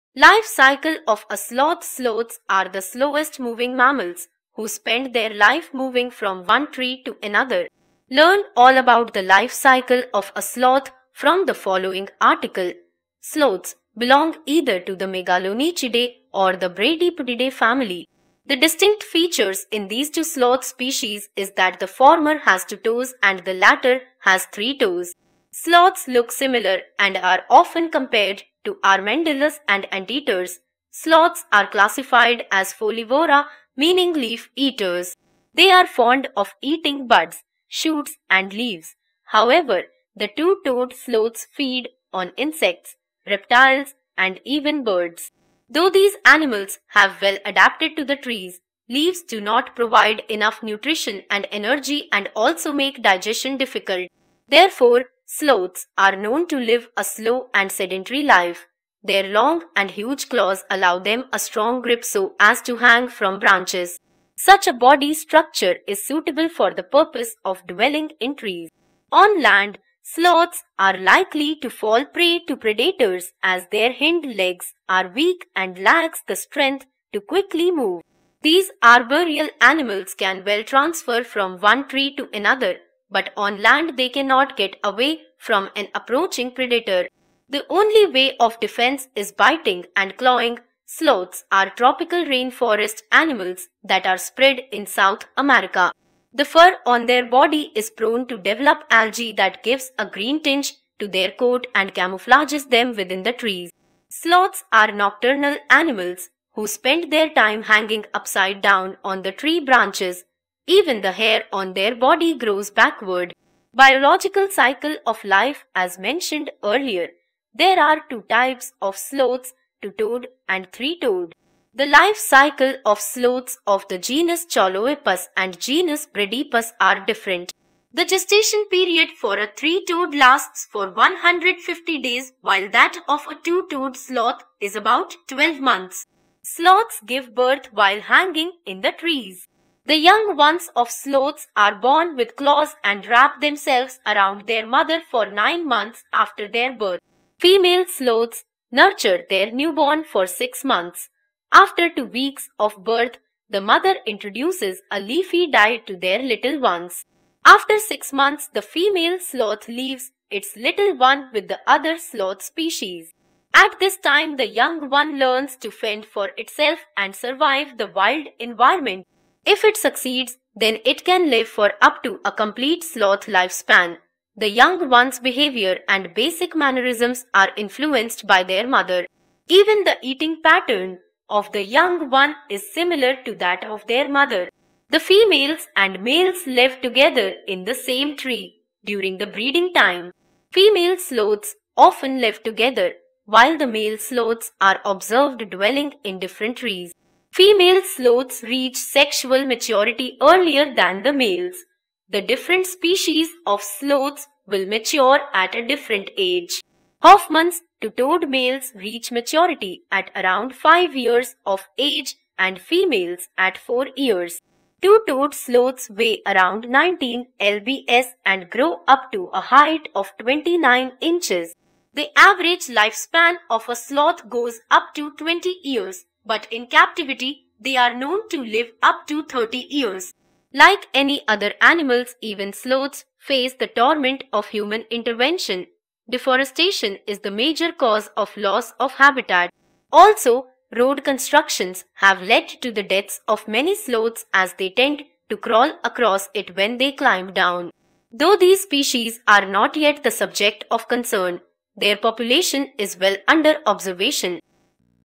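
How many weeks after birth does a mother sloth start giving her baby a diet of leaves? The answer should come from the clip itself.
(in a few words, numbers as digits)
2 weeks.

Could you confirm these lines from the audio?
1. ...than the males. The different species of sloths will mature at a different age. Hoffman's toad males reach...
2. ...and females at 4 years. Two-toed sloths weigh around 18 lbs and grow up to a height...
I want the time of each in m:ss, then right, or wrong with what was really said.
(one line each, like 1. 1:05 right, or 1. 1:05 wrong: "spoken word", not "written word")
1. 3:20 right
2. 3:32 wrong: "19", not "18".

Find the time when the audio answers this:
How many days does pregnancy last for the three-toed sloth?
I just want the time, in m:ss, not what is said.
2:10.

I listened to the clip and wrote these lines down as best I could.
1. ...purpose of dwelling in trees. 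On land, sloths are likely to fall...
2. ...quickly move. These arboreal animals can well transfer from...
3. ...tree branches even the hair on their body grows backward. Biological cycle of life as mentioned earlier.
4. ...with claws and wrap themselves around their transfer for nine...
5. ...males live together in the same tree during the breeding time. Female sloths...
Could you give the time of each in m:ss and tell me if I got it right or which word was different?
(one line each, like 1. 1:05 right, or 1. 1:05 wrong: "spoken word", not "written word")
1. 1:06 right
2. 1:17 right
3. 1:49 right
4. 2:22 wrong: "mother", not "transfer"
5. 3:06 right.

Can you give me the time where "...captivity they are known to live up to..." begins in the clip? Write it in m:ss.
3:46.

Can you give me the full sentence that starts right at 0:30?
Sloths are classified as folivora, meaning leaf eaters.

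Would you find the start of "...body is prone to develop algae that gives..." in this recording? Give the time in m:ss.
1:37.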